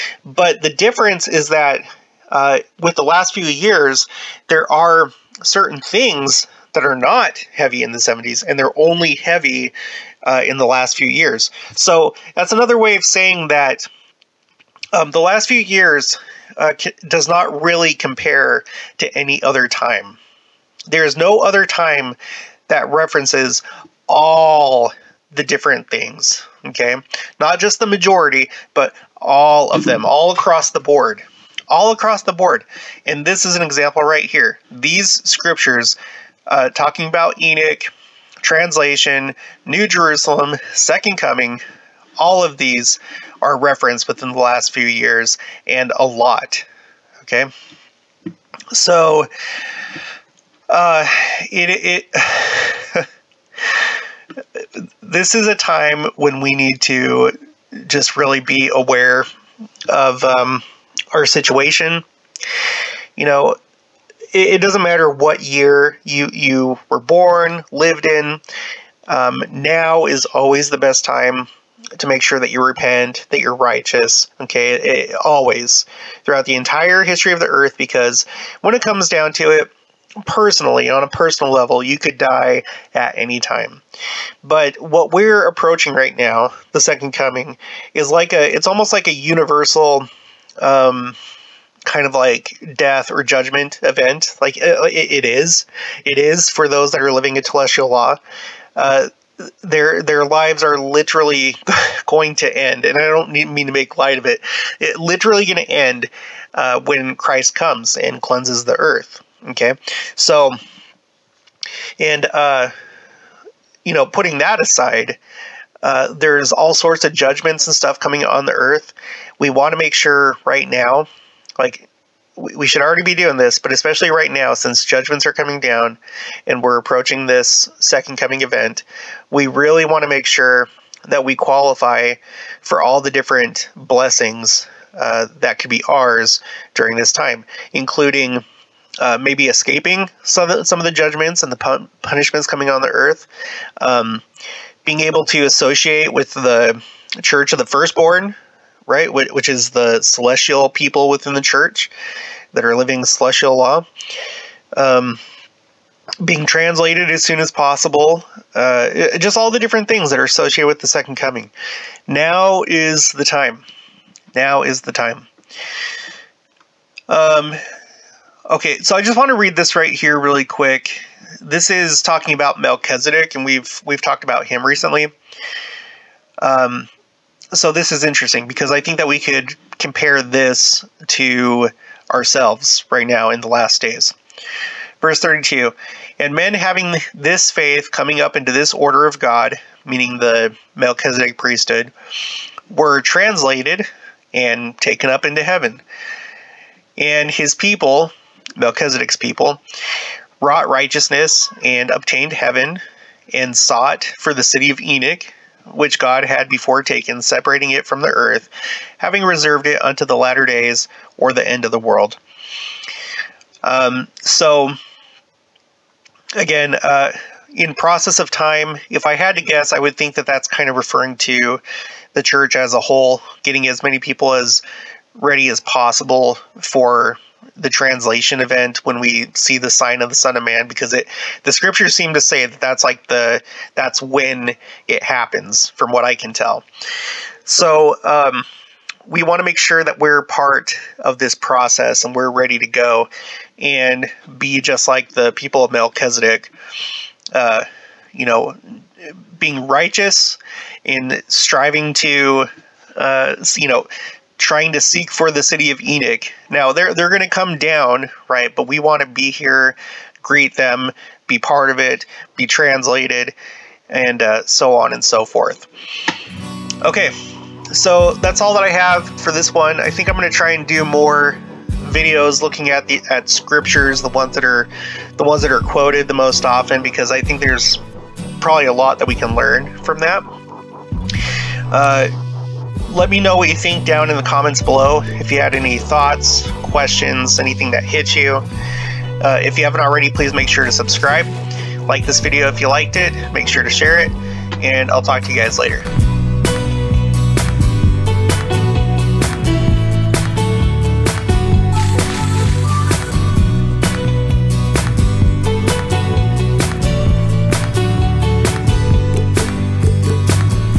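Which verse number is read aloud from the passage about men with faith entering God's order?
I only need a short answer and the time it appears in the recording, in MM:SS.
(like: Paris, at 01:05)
32, at 03:05.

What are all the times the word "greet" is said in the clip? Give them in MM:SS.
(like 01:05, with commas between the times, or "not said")
04:20.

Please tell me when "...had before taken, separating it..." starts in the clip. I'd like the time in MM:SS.
03:26.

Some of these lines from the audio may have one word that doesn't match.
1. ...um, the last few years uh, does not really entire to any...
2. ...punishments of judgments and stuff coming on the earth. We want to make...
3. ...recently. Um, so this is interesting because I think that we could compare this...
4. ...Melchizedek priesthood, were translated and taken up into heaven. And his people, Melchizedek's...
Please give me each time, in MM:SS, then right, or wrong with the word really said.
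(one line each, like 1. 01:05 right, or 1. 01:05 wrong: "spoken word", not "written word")
1. 00:14 wrong: "compare", not "entire"
2. 01:56 wrong: "sorts", not "punishments"
3. 02:54 right
4. 03:10 right.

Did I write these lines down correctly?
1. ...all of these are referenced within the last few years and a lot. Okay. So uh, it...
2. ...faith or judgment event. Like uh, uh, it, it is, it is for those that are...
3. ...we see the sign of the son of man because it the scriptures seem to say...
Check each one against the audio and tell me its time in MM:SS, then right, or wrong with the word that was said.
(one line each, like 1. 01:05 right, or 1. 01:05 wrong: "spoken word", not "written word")
1. 00:42 right
2. 01:32 wrong: "death", not "faith"
3. 03:48 right.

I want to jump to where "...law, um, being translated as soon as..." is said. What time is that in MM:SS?
02:33.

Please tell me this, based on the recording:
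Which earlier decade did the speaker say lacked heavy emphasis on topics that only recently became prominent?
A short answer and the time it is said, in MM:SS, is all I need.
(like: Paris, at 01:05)
the 70s, at 00:07.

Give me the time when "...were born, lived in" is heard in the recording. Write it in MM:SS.
01:06.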